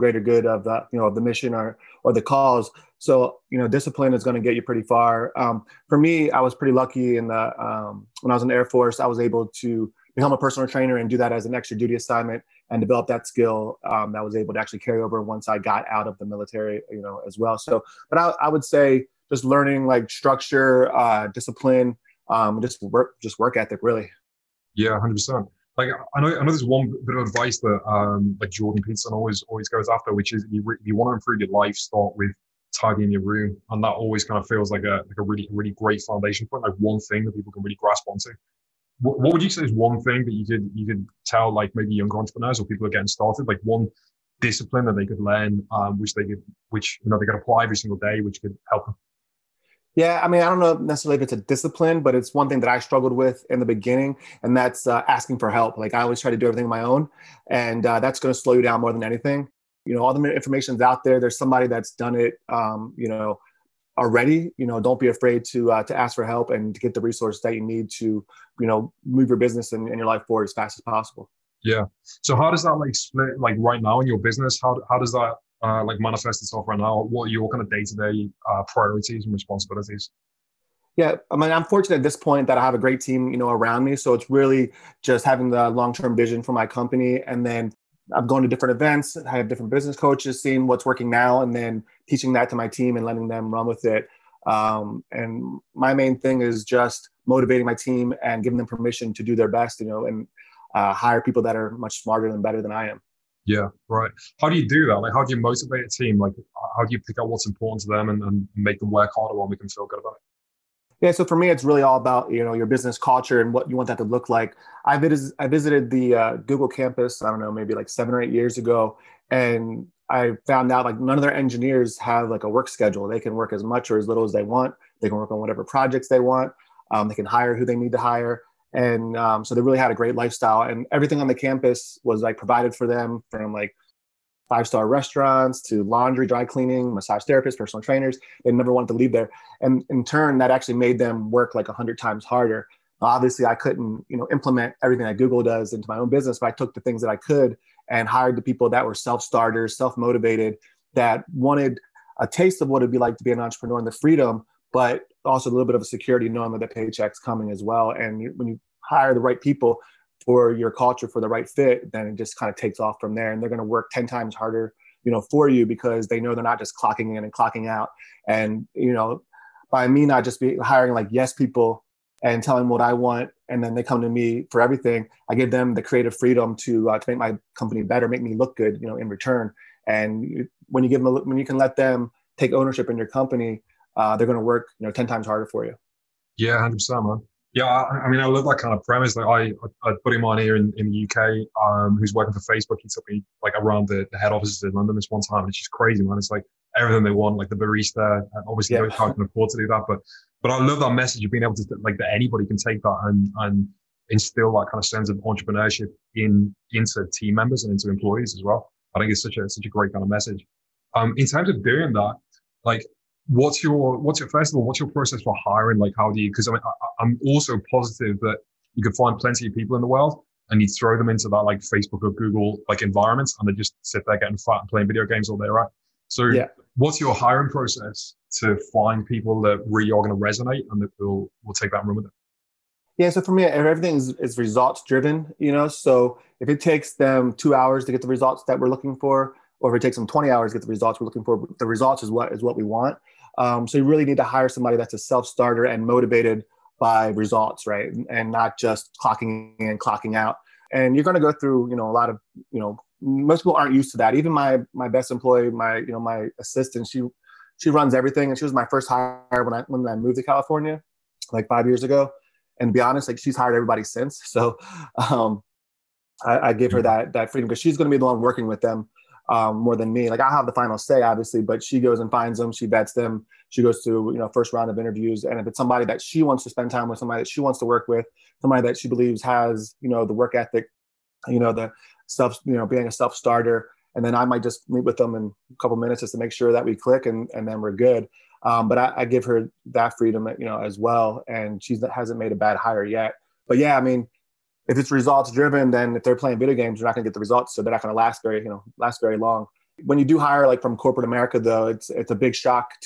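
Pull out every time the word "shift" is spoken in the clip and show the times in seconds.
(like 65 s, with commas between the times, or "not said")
not said.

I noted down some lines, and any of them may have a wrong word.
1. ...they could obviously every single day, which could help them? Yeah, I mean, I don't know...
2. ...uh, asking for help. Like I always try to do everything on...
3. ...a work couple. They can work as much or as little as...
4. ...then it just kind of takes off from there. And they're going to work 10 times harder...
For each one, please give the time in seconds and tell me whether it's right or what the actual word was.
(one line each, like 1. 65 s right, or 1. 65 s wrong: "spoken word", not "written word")
1. 47 s wrong: "apply", not "obviously"
2. 54 s right
3. 122 s wrong: "schedule", not "couple"
4. 161 s right.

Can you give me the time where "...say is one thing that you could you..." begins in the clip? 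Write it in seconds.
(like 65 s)
39 s.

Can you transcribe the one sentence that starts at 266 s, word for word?
that that freedom because she's going to be the one working with them um, more than me.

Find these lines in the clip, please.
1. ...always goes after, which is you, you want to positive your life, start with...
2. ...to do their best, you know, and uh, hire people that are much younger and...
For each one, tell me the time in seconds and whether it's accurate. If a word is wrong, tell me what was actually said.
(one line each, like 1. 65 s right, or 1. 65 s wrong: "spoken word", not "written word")
1. 29 s wrong: "improve", not "positive"
2. 99 s wrong: "smarter", not "younger".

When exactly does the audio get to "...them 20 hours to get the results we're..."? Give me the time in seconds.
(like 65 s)
239 s.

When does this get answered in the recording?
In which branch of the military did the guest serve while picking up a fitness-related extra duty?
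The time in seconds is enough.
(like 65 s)
8 s.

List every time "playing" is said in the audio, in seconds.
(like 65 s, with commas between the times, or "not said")
224 s, 296 s.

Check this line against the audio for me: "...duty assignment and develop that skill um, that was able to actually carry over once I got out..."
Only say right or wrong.
right.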